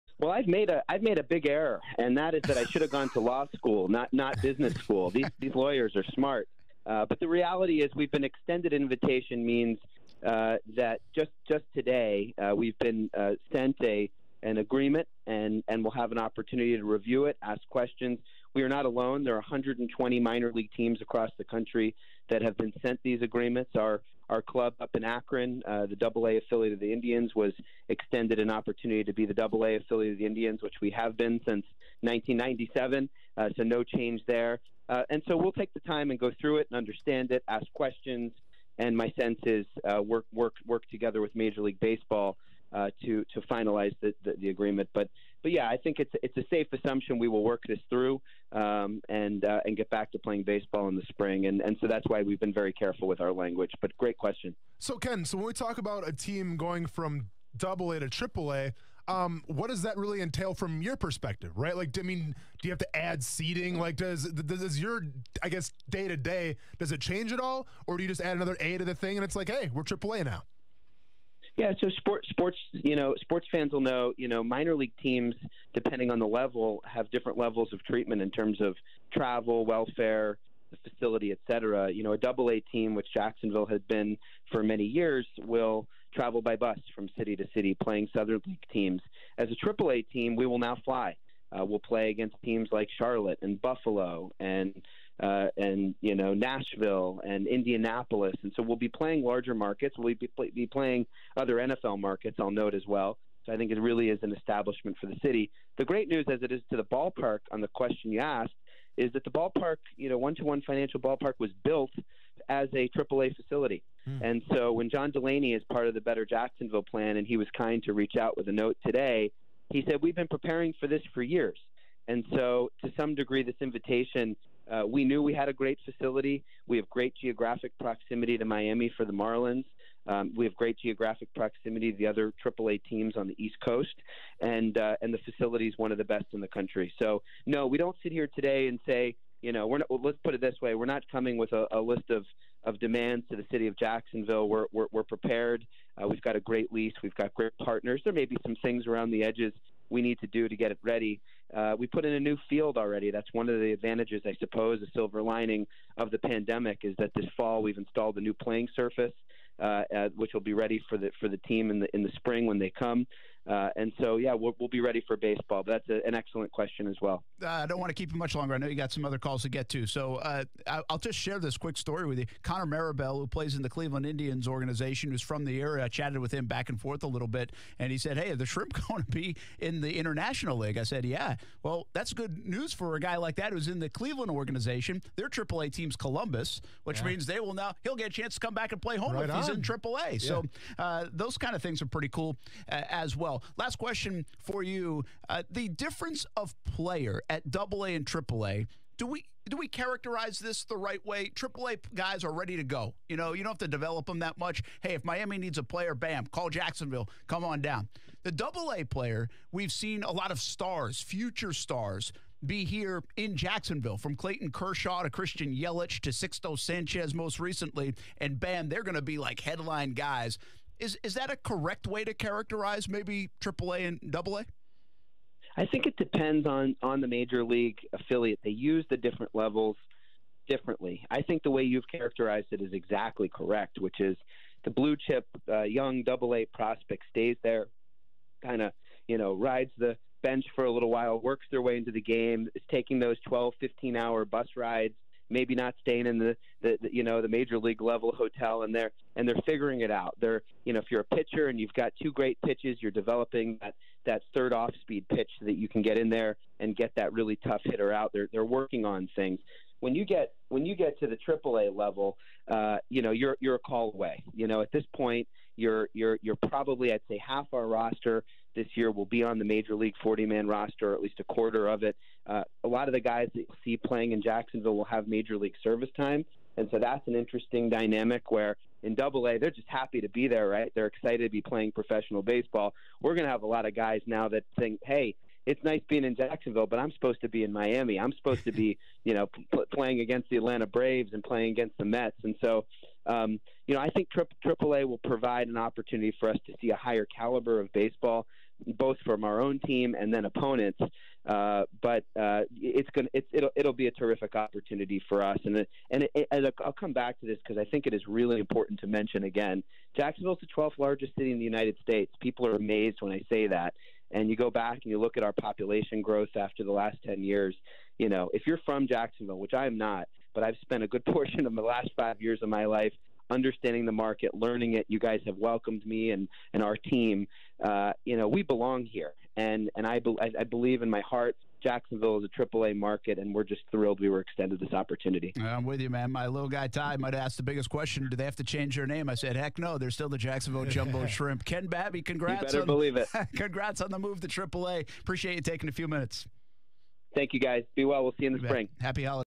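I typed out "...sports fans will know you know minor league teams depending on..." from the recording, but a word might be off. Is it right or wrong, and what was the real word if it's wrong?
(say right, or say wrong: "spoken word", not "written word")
right.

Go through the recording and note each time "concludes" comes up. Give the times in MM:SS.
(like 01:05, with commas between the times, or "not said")
not said.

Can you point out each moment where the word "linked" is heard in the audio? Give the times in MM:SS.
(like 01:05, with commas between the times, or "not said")
not said.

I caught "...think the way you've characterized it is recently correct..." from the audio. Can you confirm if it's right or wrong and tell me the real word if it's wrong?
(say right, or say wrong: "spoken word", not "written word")
wrong: "exactly", not "recently".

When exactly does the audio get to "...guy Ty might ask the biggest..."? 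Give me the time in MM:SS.
05:36.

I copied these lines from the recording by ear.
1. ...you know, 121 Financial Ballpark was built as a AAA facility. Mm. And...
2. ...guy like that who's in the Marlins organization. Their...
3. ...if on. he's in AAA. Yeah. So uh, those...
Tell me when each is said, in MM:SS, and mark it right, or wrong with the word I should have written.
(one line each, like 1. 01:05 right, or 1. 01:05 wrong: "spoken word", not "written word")
1. 01:49 right
2. 03:02 wrong: "Cleveland", not "Marlins"
3. 03:09 right.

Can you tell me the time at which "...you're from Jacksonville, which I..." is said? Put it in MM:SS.
05:18.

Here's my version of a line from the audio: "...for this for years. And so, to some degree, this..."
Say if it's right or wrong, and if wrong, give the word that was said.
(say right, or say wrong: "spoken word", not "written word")
right.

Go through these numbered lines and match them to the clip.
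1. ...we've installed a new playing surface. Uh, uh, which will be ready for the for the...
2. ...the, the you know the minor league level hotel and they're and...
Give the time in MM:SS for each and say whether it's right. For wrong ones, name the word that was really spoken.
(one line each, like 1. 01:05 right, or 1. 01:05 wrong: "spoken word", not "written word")
1. 02:37 right
2. 04:06 wrong: "major", not "minor".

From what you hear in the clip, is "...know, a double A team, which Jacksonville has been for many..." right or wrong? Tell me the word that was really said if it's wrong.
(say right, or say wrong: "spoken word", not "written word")
right.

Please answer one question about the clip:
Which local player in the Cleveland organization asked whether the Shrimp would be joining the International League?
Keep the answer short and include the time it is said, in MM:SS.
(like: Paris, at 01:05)
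Connor Marabell, at 02:52.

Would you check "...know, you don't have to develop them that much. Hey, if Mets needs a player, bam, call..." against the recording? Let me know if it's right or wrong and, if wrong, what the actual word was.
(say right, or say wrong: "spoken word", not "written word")
wrong: "Miami", not "Mets".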